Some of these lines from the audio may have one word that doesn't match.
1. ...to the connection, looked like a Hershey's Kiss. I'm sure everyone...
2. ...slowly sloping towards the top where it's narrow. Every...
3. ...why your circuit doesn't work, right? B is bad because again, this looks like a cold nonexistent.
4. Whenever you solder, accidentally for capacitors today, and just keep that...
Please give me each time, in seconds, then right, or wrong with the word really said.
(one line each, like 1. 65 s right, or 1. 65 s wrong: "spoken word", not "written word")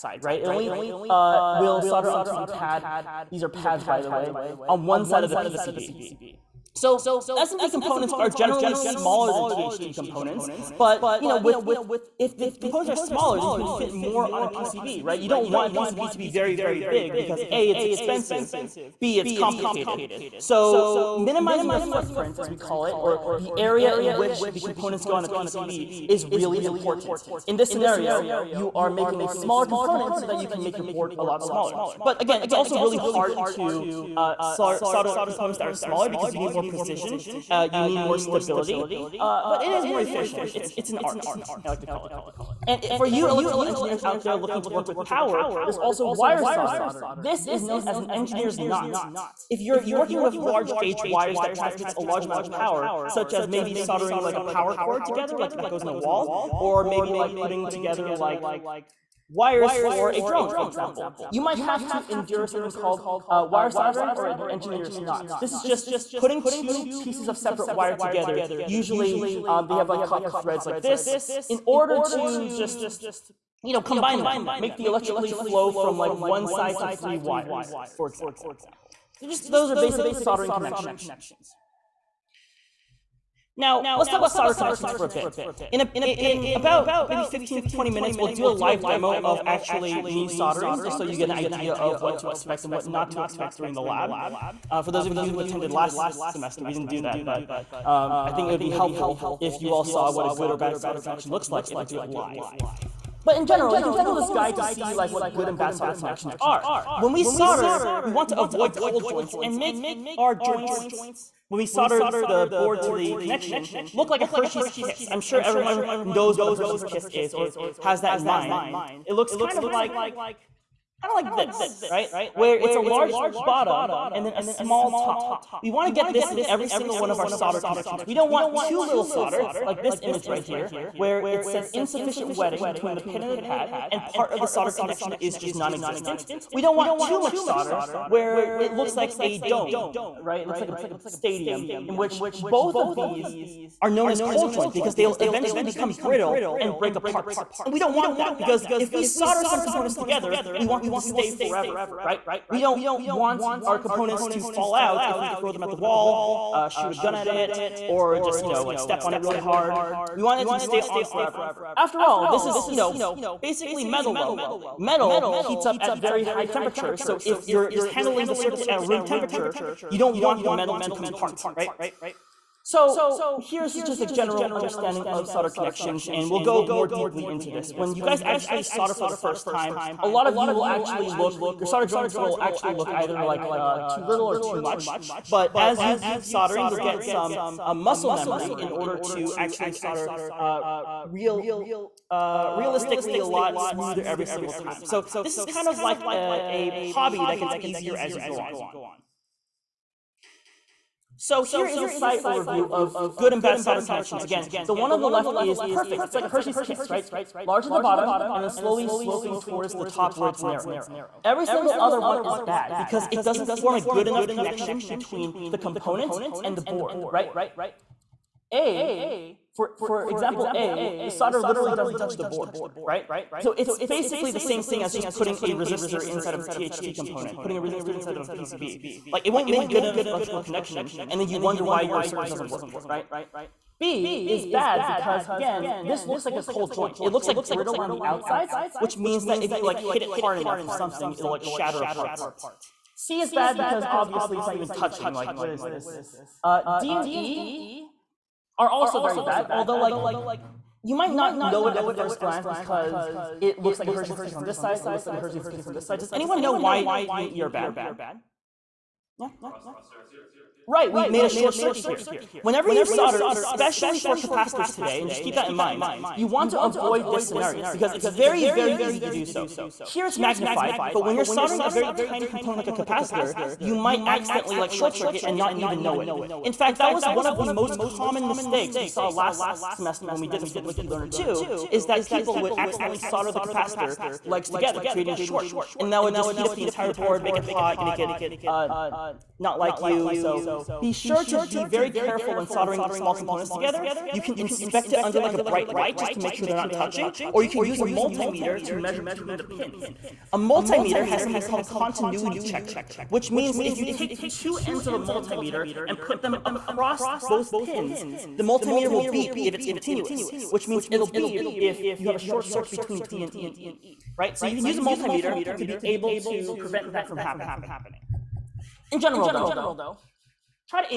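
1. 112 s right
2. 208 s right
3. 231 s wrong: "joint", not "nonexistent"
4. 262 s wrong: "especially", not "accidentally".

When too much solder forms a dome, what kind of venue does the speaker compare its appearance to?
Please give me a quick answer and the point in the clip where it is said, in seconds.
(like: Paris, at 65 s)
a stadium, at 140 s.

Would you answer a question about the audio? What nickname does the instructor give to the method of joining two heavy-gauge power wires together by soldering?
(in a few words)
engineer's knot.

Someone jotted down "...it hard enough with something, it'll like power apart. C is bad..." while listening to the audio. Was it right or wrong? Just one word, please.
wrong.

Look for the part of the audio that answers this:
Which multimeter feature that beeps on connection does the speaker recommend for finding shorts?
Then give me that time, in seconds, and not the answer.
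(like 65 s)
301 s.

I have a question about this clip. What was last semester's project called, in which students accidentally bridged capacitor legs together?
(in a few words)
Blinky Learner 2.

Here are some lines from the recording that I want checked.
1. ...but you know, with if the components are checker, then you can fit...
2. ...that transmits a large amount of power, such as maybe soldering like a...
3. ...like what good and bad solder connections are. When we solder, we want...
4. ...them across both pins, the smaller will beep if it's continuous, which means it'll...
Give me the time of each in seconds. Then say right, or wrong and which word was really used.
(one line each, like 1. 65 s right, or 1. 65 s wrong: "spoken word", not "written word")
1. 10 s wrong: "smaller", not "checker"
2. 51 s right
3. 104 s right
4. 306 s wrong: "multimeter", not "smaller".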